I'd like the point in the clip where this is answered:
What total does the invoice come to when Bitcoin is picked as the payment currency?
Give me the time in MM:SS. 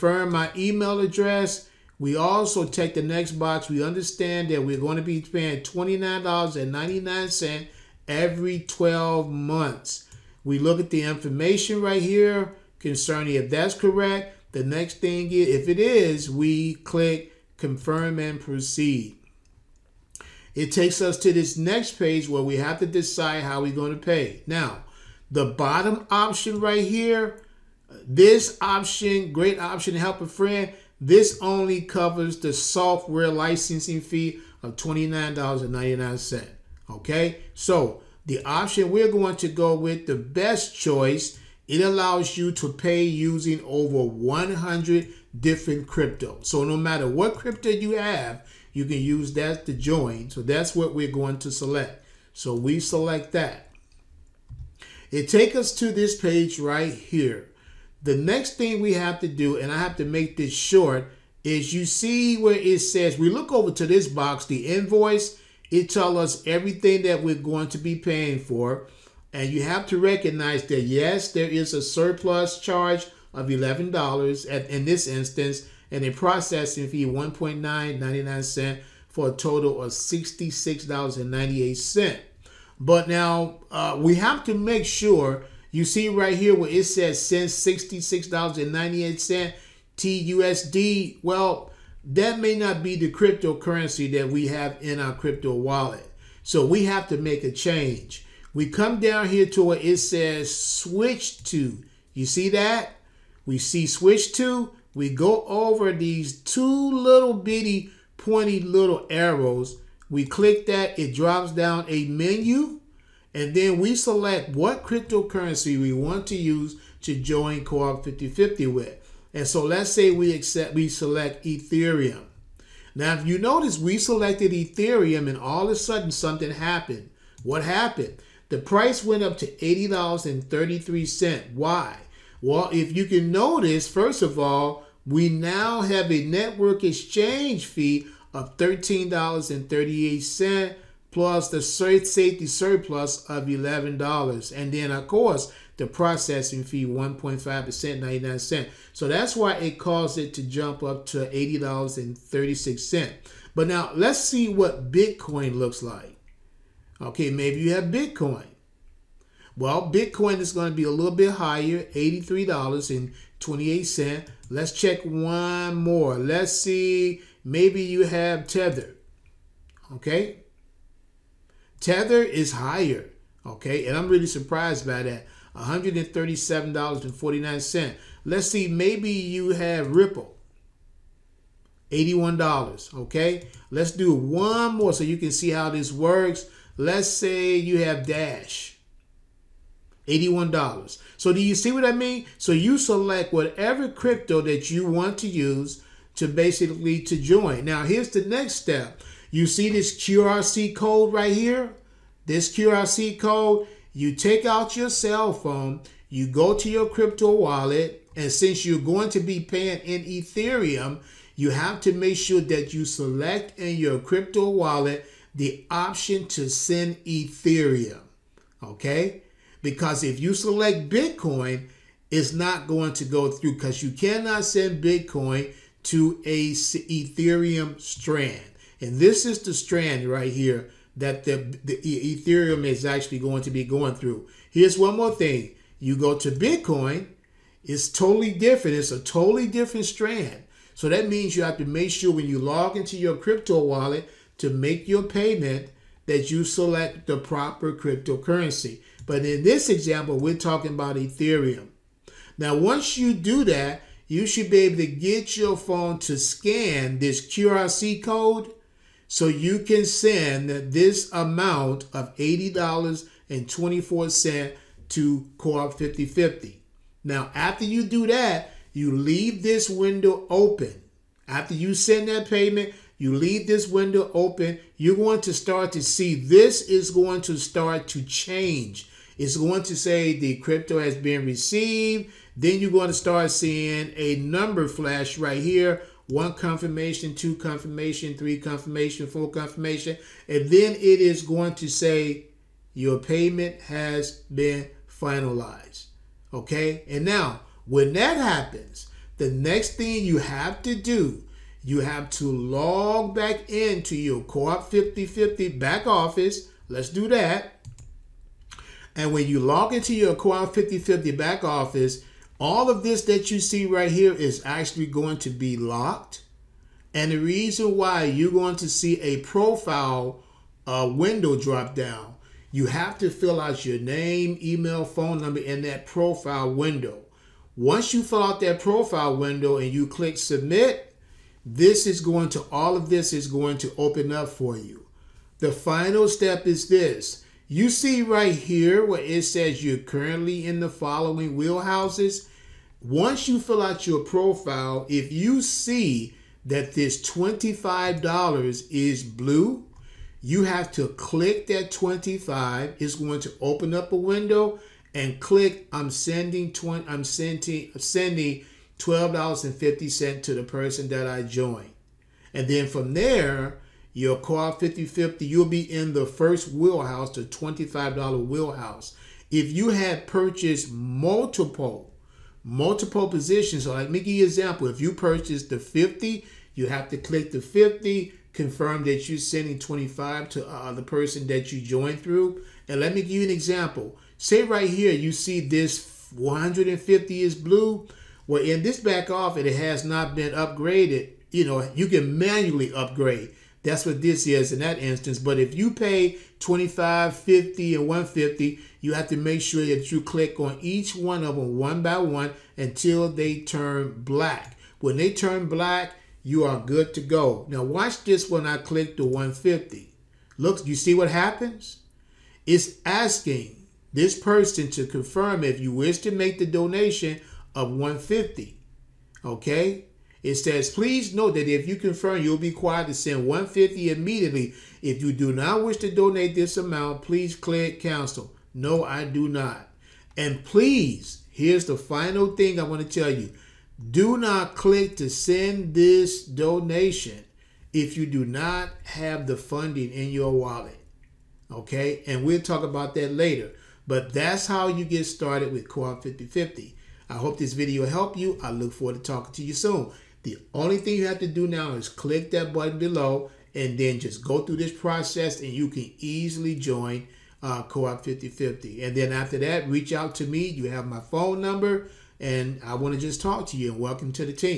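02:41.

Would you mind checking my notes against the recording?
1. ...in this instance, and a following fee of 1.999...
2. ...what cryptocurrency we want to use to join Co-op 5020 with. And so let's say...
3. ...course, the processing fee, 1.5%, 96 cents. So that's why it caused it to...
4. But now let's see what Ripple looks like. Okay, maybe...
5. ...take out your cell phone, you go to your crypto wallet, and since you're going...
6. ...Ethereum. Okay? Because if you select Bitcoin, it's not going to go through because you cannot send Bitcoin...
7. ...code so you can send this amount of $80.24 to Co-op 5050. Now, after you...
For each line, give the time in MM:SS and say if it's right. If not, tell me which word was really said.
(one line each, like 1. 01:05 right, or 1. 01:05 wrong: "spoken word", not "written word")
1. 01:14 wrong: "processing", not "following"
2. 01:54 wrong: "5050", not "5020"
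3. 02:25 wrong: "99", not "96"
4. 02:33 wrong: "Bitcoin", not "Ripple"
5. 03:24 right
6. 03:37 right
7. 04:18 right.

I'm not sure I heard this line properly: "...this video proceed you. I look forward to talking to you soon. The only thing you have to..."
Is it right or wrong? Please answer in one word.
wrong.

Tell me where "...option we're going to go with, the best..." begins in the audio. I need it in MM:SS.
00:38.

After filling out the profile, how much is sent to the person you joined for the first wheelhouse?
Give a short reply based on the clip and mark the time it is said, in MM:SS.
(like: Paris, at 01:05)
$12.50, at 05:58.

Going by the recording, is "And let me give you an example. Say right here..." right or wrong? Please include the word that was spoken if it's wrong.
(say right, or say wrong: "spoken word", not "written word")
right.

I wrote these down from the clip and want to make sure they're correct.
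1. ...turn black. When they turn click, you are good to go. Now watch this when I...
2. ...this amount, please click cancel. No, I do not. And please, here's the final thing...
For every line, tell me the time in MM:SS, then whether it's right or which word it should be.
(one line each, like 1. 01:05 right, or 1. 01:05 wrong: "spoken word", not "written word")
1. 06:43 wrong: "black", not "click"
2. 07:06 right.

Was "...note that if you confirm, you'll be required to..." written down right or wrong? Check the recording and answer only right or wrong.
right.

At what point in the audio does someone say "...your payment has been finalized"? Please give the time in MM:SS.
04:52.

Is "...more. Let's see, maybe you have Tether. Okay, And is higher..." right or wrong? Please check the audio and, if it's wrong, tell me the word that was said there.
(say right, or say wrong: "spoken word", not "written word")
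wrong: "Tether", not "And".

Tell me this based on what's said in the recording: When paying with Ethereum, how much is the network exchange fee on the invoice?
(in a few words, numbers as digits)
$13.38.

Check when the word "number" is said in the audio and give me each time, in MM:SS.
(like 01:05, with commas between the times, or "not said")
04:44, 05:25, 07:41.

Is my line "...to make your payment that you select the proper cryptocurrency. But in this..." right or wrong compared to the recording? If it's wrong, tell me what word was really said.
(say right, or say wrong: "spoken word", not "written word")
right.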